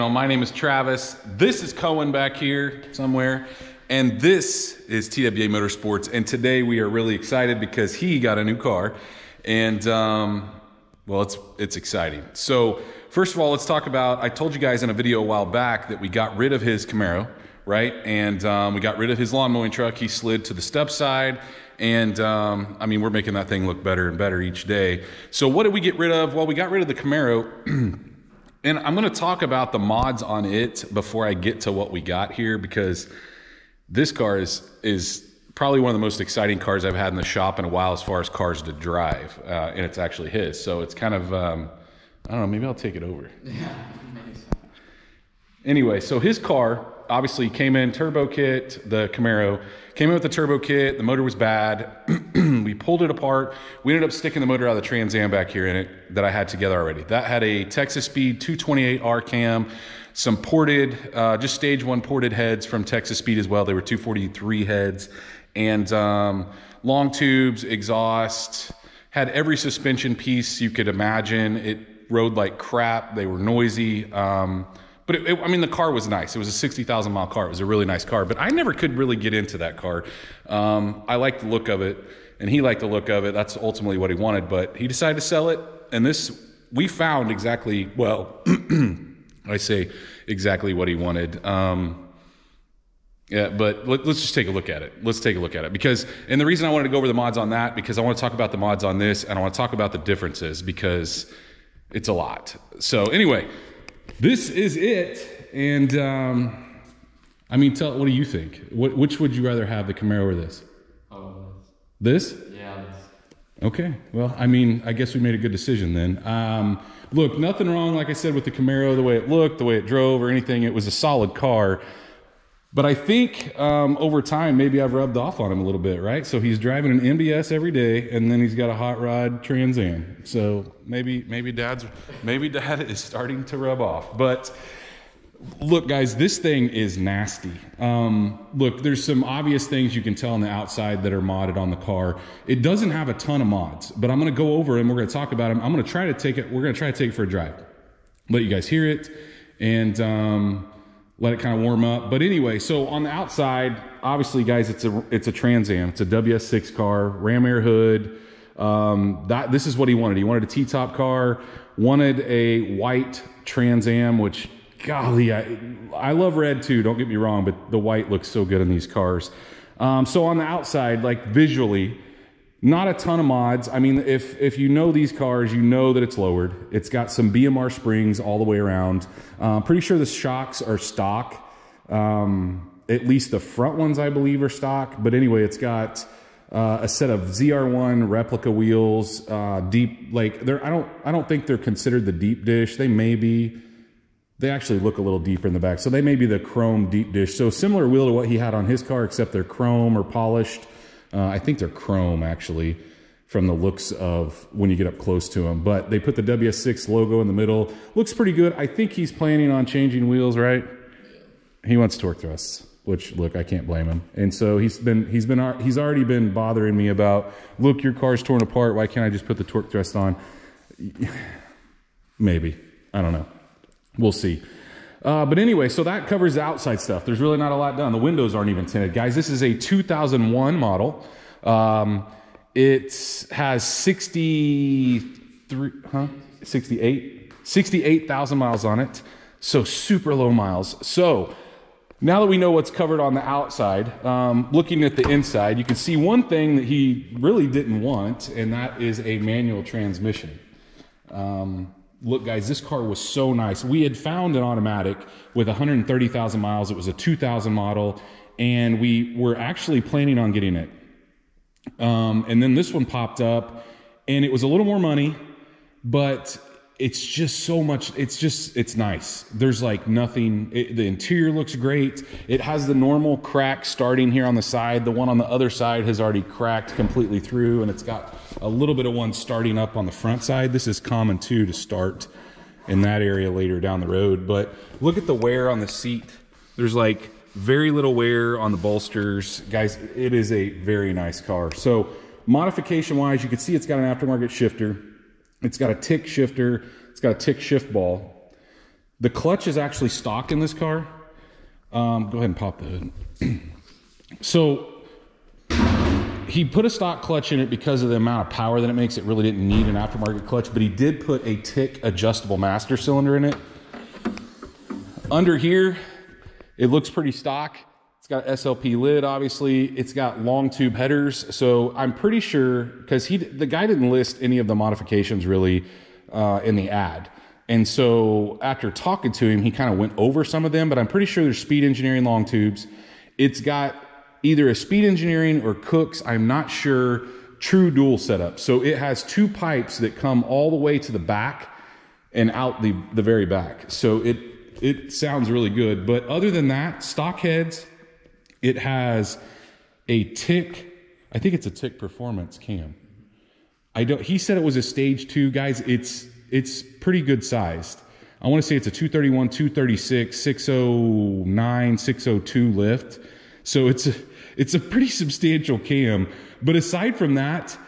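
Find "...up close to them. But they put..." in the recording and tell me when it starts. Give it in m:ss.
3:24.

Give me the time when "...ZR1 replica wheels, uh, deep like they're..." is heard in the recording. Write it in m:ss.
3:07.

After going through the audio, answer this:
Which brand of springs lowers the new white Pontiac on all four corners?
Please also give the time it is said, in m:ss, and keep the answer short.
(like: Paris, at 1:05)
BMR, at 2:57.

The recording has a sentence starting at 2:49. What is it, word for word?
Um, so on the outside, like visually, not a ton of mods.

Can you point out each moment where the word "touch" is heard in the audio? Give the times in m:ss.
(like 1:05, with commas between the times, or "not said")
not said.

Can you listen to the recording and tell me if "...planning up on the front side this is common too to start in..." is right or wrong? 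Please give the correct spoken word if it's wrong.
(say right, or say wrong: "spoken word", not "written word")
wrong: "starting", not "planning".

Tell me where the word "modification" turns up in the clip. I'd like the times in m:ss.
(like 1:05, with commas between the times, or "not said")
4:52, 5:24.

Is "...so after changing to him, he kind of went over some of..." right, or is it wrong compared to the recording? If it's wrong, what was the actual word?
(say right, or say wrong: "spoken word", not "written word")
wrong: "talking", not "changing".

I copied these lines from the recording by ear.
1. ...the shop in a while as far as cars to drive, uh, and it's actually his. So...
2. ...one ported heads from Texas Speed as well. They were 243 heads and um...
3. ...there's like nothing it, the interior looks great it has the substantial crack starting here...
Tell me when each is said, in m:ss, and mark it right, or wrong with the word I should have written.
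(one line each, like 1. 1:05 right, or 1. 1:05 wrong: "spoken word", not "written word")
1. 0:37 right
2. 1:01 right
3. 4:29 wrong: "normal", not "substantial".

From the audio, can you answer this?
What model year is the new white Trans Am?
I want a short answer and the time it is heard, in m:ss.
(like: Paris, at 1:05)
2001, at 3:49.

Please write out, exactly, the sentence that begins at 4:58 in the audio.
The clutch is actually stock in this car.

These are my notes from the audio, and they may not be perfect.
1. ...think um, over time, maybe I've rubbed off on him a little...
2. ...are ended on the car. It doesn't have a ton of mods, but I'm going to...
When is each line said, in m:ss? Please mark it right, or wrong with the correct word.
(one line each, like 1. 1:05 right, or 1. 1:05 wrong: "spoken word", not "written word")
1. 2:02 right
2. 2:21 wrong: "modded", not "ended".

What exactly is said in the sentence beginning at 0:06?
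And today we are really excited because he got a new car.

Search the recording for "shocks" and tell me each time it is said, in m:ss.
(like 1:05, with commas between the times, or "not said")
3:00.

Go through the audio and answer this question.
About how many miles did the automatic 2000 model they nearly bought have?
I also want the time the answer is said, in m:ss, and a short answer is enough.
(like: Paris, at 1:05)
130,000, at 4:15.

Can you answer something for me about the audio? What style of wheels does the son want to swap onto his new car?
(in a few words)
Torque thrusts.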